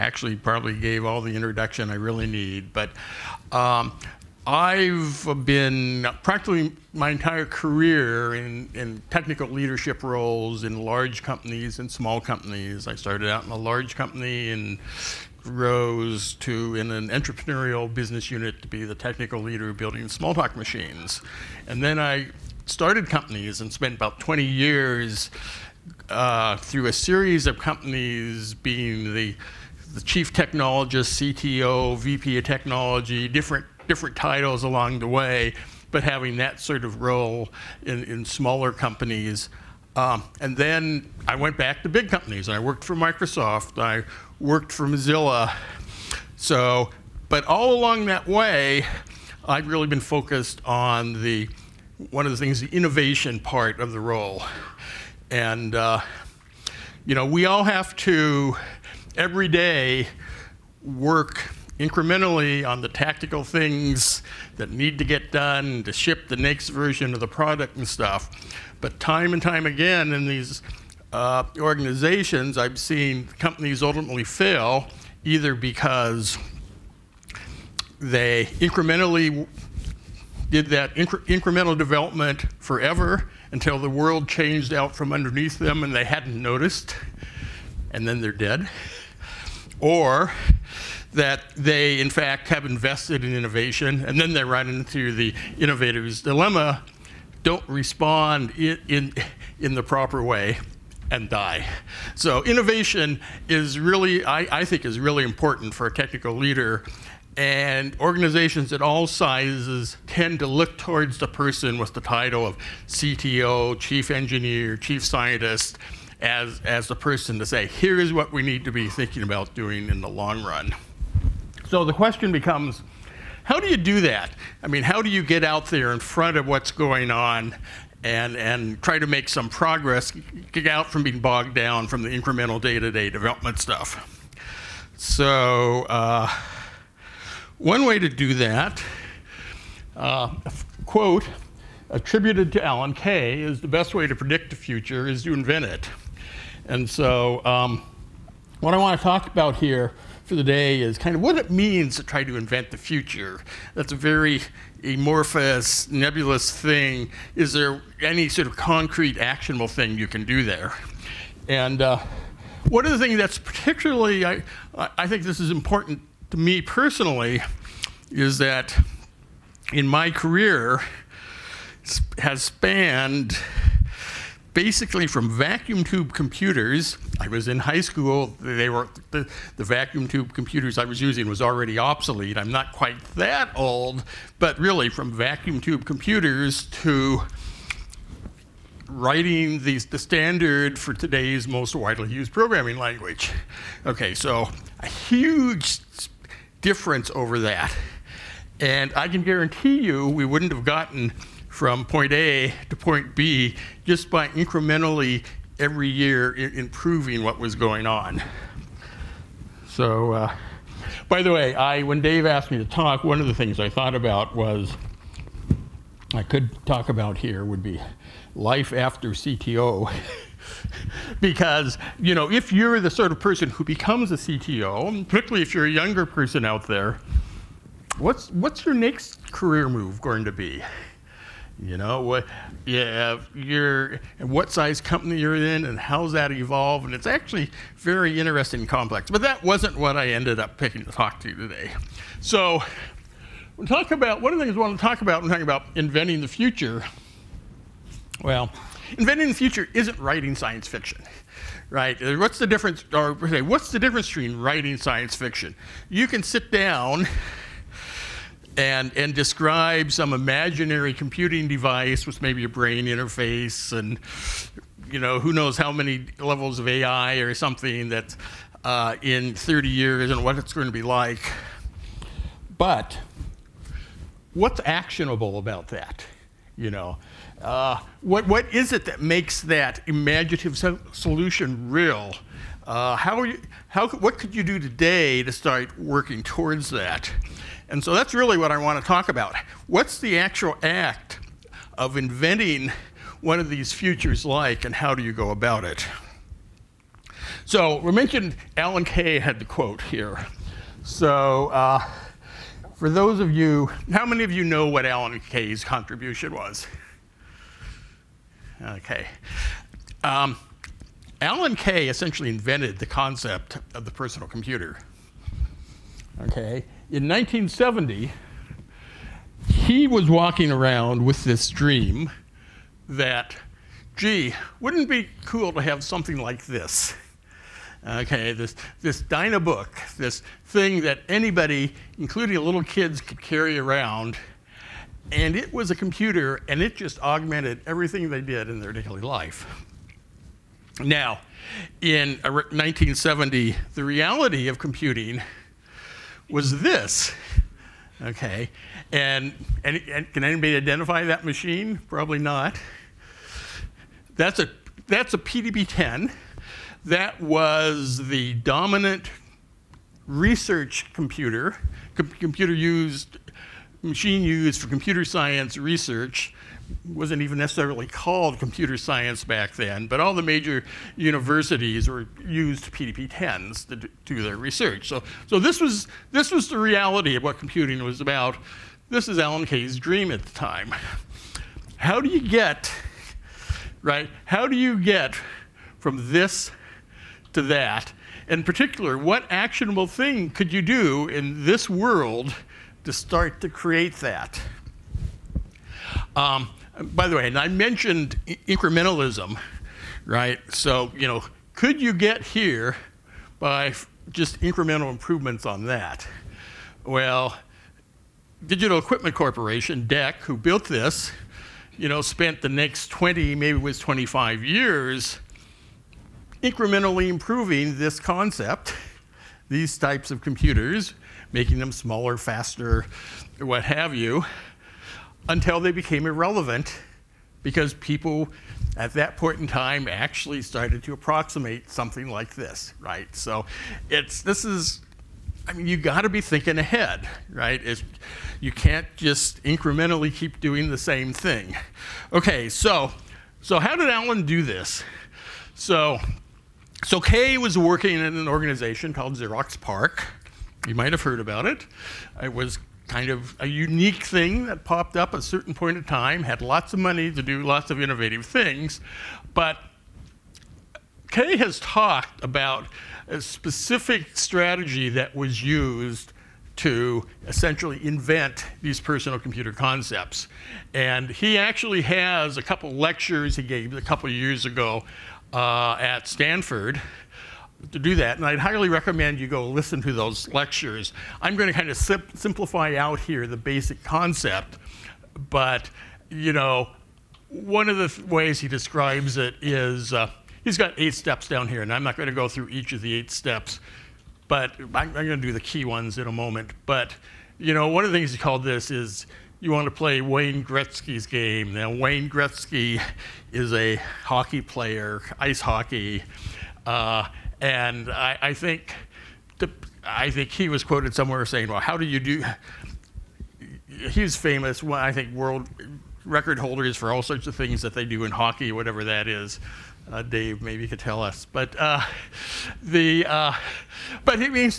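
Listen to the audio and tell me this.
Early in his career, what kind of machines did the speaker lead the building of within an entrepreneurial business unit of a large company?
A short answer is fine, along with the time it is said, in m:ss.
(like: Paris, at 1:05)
Smalltalk machines, at 0:20.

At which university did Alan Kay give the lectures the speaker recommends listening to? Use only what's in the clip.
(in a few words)
Stanford.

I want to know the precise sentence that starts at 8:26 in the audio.
Uh, and I, I think the, I think he was quoted somewhere saying, "Well, how do you do?" He's famous.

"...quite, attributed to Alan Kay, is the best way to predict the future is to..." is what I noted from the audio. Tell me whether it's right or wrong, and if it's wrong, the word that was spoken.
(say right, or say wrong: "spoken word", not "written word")
wrong: "quote", not "quite".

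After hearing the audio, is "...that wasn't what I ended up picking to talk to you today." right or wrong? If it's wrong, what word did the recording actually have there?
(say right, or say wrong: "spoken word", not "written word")
right.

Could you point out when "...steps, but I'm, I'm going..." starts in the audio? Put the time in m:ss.
8:13.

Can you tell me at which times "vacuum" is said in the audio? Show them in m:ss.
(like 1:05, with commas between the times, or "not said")
2:55, 2:59, 3:05.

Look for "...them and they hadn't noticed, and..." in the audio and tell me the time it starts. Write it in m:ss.
1:25.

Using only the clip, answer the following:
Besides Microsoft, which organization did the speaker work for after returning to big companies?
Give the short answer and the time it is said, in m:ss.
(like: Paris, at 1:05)
Mozilla, at 0:44.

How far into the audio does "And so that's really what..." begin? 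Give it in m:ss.
4:47.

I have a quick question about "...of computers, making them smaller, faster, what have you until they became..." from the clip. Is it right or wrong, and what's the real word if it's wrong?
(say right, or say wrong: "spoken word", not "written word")
right.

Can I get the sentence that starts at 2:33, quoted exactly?
That's a very amorphous, nebulous thing.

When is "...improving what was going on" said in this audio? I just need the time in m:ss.
3:26.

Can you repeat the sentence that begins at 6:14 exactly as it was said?
So, so this, was, this was the reality of what computing was about.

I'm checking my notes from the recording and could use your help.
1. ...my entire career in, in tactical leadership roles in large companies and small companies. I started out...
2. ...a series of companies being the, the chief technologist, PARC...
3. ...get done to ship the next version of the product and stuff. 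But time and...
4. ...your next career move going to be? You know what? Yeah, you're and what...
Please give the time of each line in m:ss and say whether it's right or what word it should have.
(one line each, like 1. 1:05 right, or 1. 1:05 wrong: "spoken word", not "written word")
1. 0:06 wrong: "technical", not "tactical"
2. 0:26 wrong: "CTO", not "PARC"
3. 1:05 right
4. 3:48 right.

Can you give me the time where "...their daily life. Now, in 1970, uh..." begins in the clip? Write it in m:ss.
5:38.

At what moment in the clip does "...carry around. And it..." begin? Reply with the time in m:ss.
5:33.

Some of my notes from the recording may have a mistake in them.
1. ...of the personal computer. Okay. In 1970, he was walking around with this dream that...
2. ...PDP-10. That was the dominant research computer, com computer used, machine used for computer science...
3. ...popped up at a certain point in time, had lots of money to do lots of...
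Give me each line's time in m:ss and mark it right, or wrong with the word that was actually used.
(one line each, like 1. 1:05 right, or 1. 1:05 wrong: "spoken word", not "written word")
1. 5:13 right
2. 5:55 right
3. 7:34 right.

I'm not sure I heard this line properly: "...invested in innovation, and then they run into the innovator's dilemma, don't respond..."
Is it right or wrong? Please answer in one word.
right.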